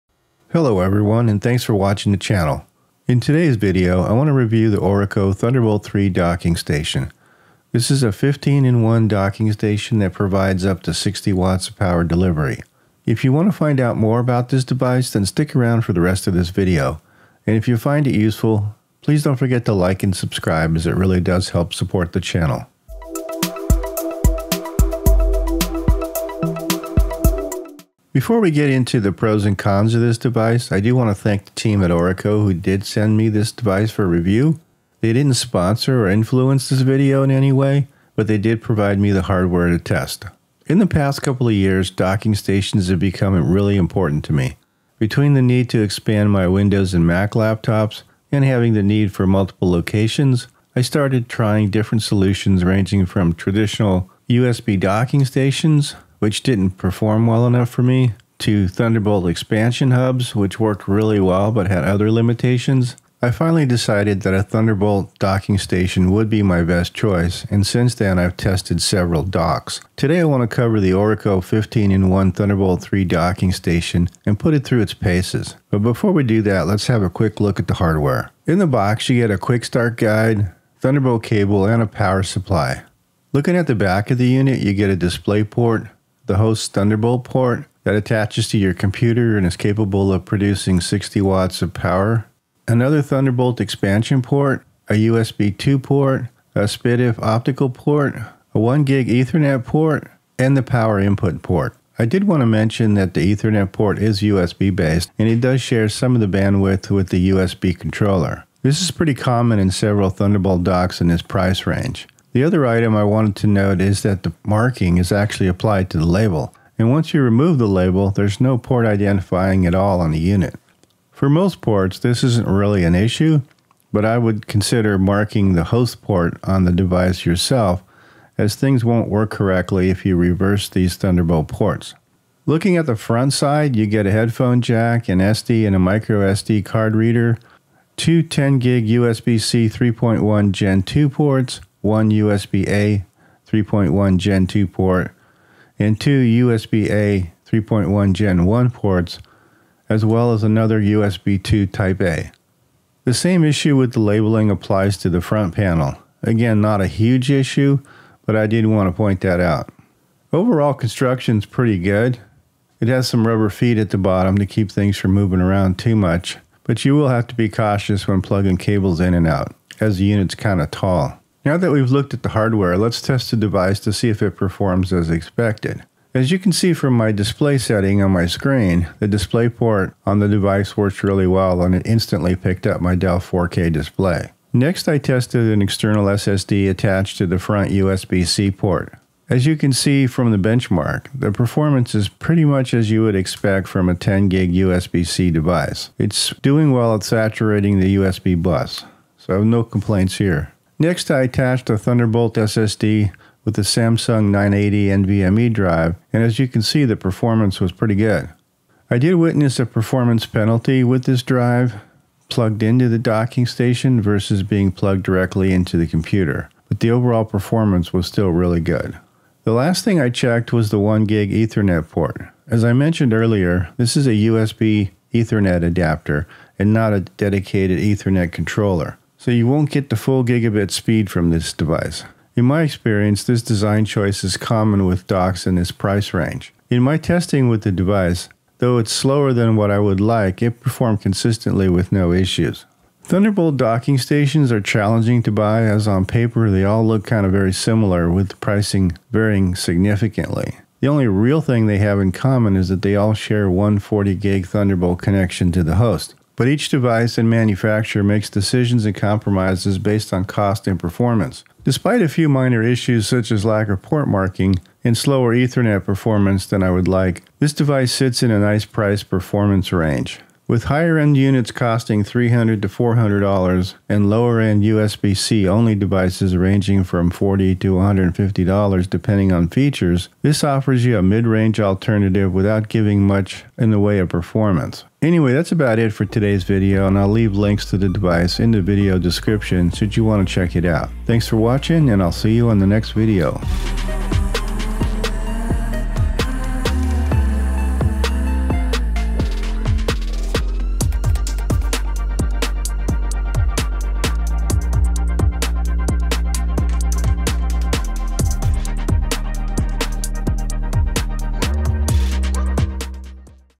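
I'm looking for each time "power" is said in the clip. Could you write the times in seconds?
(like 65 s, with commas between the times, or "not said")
11 s, 81 s, 91 s, 100 s.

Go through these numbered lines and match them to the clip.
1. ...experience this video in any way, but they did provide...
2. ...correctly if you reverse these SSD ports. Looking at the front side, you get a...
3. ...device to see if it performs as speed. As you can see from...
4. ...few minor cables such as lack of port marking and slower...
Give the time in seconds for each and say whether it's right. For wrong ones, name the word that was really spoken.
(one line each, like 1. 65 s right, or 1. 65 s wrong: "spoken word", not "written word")
1. 36 s wrong: "influence", not "experience"
2. 129 s wrong: "Thunderbolt", not "SSD"
3. 173 s wrong: "expected", not "speed"
4. 262 s wrong: "issues", not "cables".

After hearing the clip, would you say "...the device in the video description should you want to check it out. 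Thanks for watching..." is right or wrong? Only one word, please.
right.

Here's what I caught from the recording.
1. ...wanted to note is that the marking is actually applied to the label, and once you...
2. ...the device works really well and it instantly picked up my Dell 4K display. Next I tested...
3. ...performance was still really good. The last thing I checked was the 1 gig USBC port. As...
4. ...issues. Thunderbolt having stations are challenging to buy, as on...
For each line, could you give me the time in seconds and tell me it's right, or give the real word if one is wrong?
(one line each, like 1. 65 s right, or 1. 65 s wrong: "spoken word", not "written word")
1. 113 s right
2. 180 s right
3. 217 s wrong: "Ethernet", not "USBC"
4. 242 s wrong: "docking", not "having".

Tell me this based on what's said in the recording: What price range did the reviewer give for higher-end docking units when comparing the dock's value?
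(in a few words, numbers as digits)
$300 to $400.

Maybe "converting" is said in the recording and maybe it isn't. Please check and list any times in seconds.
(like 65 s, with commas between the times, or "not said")
not said.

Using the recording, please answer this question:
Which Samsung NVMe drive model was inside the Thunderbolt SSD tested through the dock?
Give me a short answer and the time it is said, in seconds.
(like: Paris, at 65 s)
980, at 204 s.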